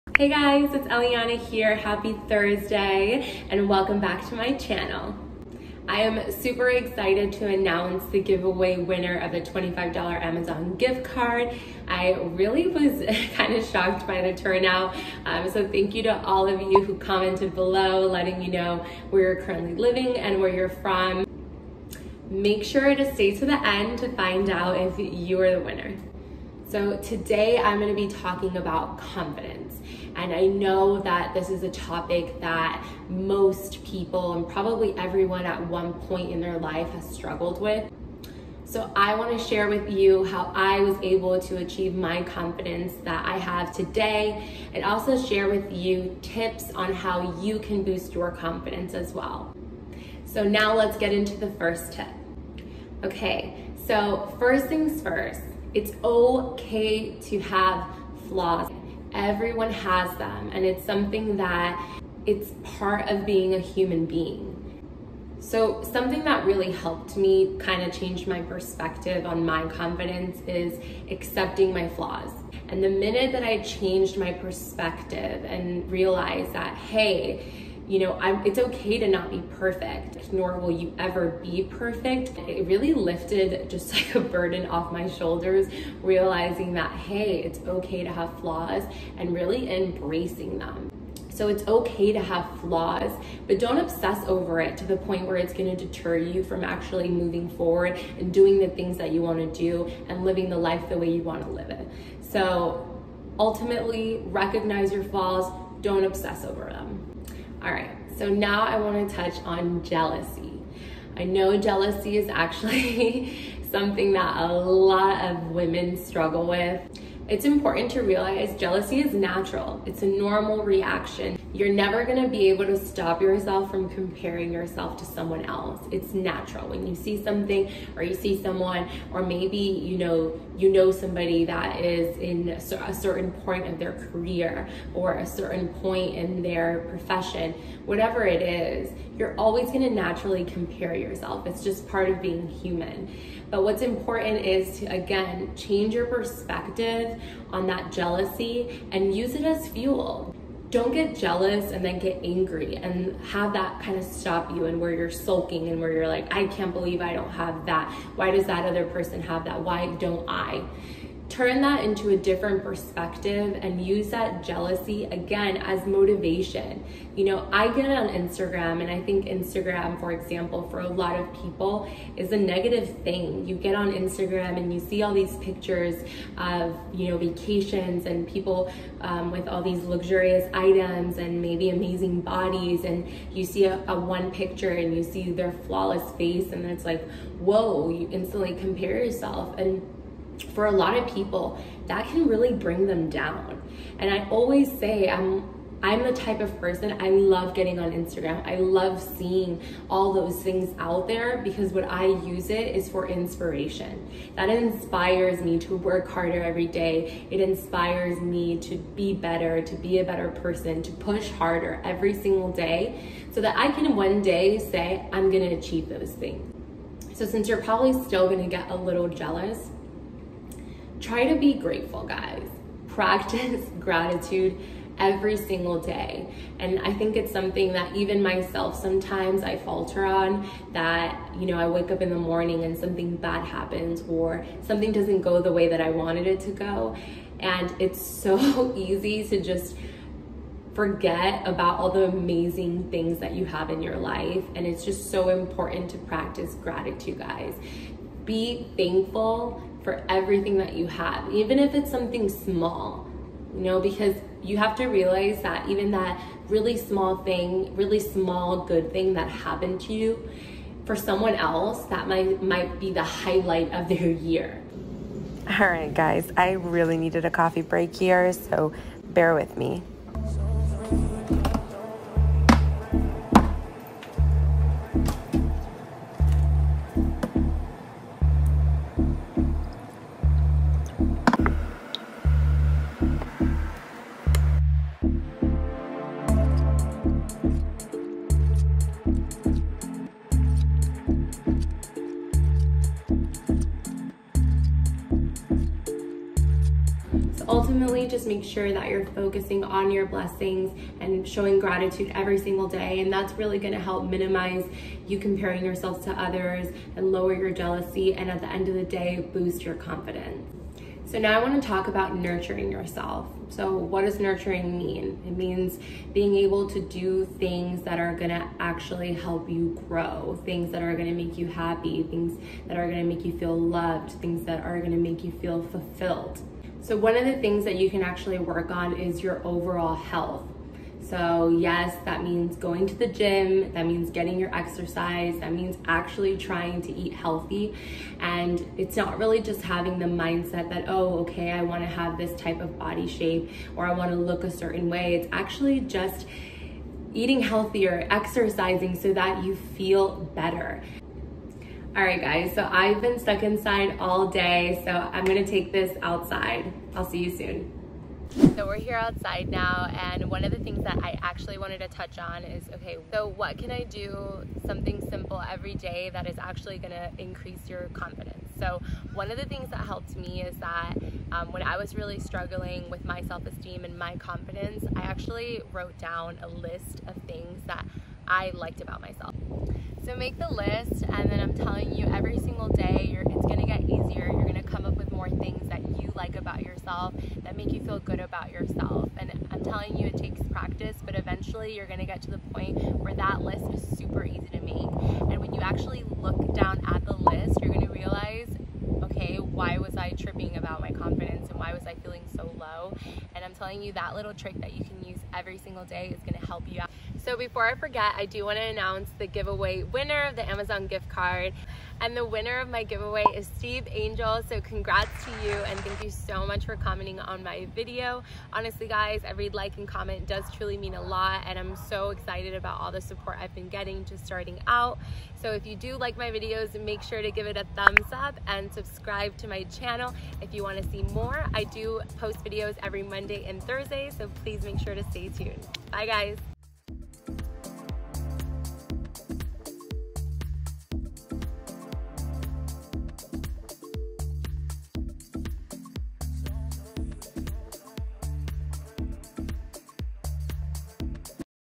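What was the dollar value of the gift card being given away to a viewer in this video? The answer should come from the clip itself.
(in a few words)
$25.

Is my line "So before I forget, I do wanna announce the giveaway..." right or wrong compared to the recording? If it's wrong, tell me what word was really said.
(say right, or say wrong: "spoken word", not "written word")
right.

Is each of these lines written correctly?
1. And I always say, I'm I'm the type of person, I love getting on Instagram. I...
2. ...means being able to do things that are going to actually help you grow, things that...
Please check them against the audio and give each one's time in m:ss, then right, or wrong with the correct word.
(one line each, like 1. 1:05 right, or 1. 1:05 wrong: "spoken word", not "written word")
1. 3:13 right
2. 5:15 right.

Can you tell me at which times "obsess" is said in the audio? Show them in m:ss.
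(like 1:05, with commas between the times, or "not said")
1:33, 1:46.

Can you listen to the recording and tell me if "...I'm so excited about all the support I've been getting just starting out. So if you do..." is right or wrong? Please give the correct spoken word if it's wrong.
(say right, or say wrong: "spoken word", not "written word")
right.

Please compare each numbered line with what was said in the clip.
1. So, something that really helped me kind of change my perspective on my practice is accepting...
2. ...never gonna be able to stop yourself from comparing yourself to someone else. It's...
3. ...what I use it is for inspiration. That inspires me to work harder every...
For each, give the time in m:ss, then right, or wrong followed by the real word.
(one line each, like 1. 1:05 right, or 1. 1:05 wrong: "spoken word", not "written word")
1. 1:05 wrong: "confidence", not "practice"
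2. 2:01 right
3. 3:21 right.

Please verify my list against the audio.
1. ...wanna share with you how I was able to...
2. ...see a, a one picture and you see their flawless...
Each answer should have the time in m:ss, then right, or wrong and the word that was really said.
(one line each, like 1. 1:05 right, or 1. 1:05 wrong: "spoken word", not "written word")
1. 0:39 right
2. 3:03 right.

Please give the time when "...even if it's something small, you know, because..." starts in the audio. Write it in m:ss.
4:11.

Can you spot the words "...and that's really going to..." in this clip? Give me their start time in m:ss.
5:02.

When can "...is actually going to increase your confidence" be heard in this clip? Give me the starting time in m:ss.
6:06.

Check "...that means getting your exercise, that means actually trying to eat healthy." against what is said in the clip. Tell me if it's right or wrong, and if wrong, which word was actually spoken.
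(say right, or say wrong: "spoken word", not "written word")
right.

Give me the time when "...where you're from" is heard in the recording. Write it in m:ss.
0:20.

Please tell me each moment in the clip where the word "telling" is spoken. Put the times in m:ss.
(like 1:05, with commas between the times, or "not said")
6:21, 6:29, 6:43.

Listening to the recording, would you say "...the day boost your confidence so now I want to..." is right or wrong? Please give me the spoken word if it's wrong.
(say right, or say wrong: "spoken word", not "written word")
right.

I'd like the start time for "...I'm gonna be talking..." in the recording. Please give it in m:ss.
0:27.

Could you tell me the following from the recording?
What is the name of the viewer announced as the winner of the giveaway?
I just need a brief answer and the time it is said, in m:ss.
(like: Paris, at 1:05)
Steve Angel, at 6:53.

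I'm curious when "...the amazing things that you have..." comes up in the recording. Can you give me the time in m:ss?
4:01.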